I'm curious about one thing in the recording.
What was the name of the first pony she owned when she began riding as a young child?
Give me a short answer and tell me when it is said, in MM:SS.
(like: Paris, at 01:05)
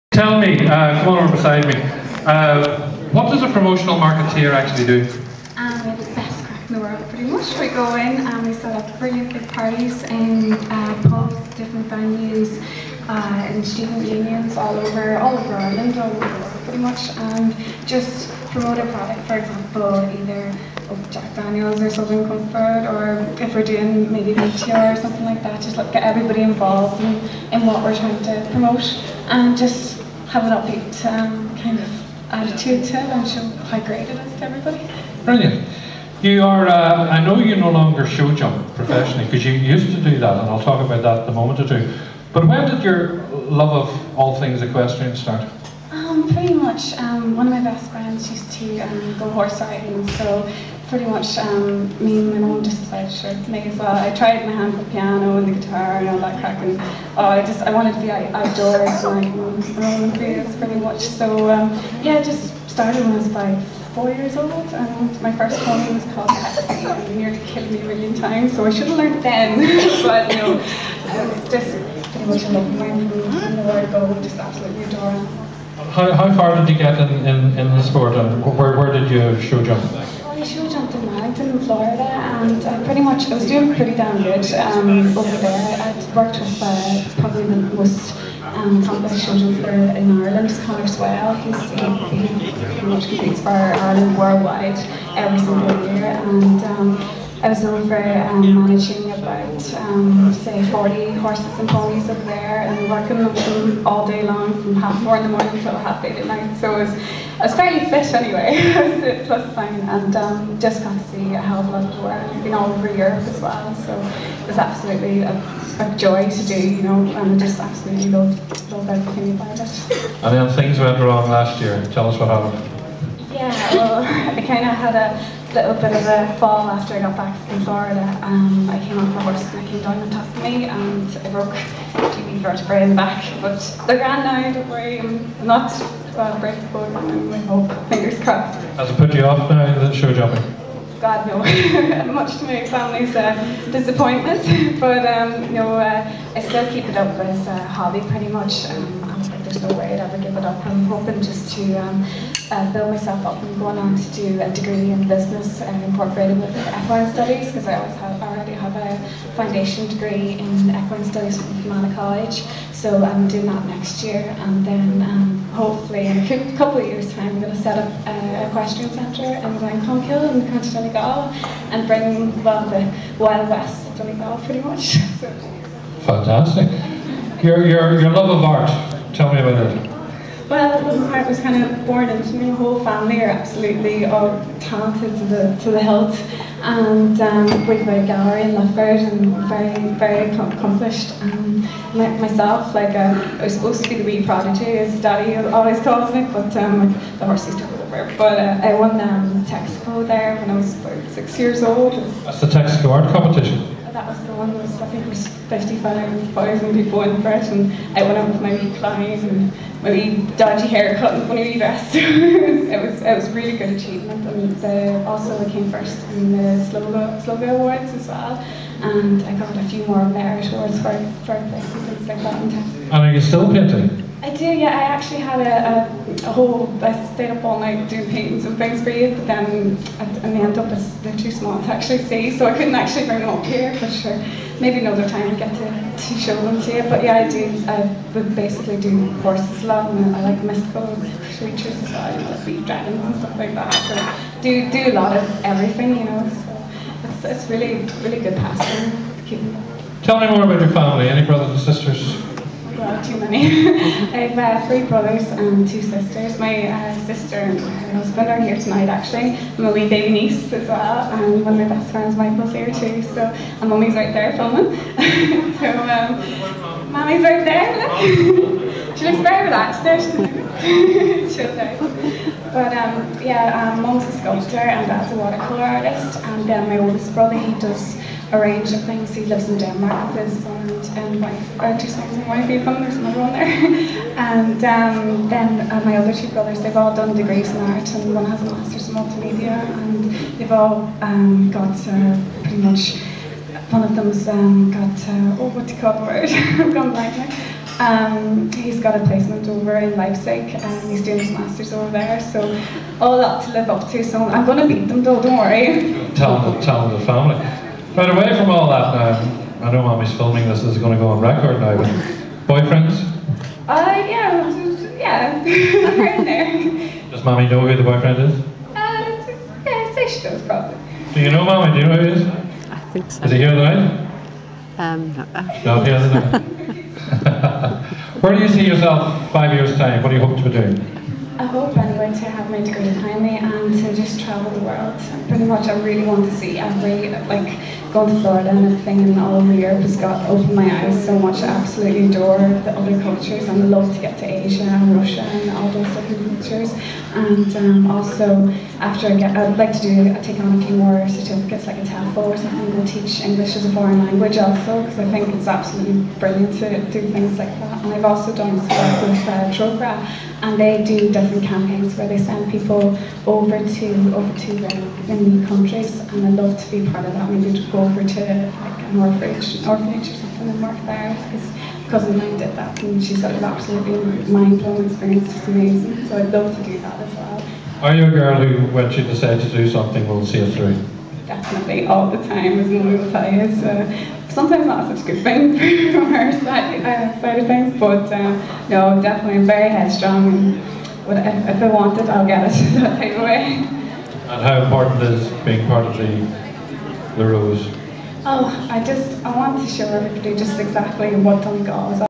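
Pepsi, at 01:06.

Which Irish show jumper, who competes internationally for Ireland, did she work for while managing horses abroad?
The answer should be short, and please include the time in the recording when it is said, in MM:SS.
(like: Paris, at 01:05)
Conor Swail, at 01:30.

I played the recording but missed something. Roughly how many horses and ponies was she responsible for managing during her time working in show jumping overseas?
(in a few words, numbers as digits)
40.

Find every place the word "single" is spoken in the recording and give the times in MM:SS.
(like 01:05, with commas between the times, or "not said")
01:35.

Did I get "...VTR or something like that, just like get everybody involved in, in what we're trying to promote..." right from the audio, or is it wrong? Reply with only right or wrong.
right.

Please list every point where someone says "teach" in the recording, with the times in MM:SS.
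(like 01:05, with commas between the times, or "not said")
05:52.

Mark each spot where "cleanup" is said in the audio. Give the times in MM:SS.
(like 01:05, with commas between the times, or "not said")
not said.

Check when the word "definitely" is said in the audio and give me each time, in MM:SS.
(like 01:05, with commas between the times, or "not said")
06:21, 06:29.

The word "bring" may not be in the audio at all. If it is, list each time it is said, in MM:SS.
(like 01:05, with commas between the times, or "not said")
02:51, 03:53.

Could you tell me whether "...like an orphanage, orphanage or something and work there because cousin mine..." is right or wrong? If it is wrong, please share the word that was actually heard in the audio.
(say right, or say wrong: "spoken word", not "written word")
right.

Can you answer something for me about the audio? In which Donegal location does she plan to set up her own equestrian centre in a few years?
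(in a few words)
Glencolumbkille.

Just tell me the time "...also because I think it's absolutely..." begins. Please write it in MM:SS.
05:54.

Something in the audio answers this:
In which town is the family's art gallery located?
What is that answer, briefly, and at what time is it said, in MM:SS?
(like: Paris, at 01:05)
Lifford, at 03:08.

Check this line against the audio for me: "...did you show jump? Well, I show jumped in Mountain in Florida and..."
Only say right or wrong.
right.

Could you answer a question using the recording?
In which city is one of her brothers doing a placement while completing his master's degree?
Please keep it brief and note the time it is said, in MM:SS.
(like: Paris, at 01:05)
Leipzig, at 04:59.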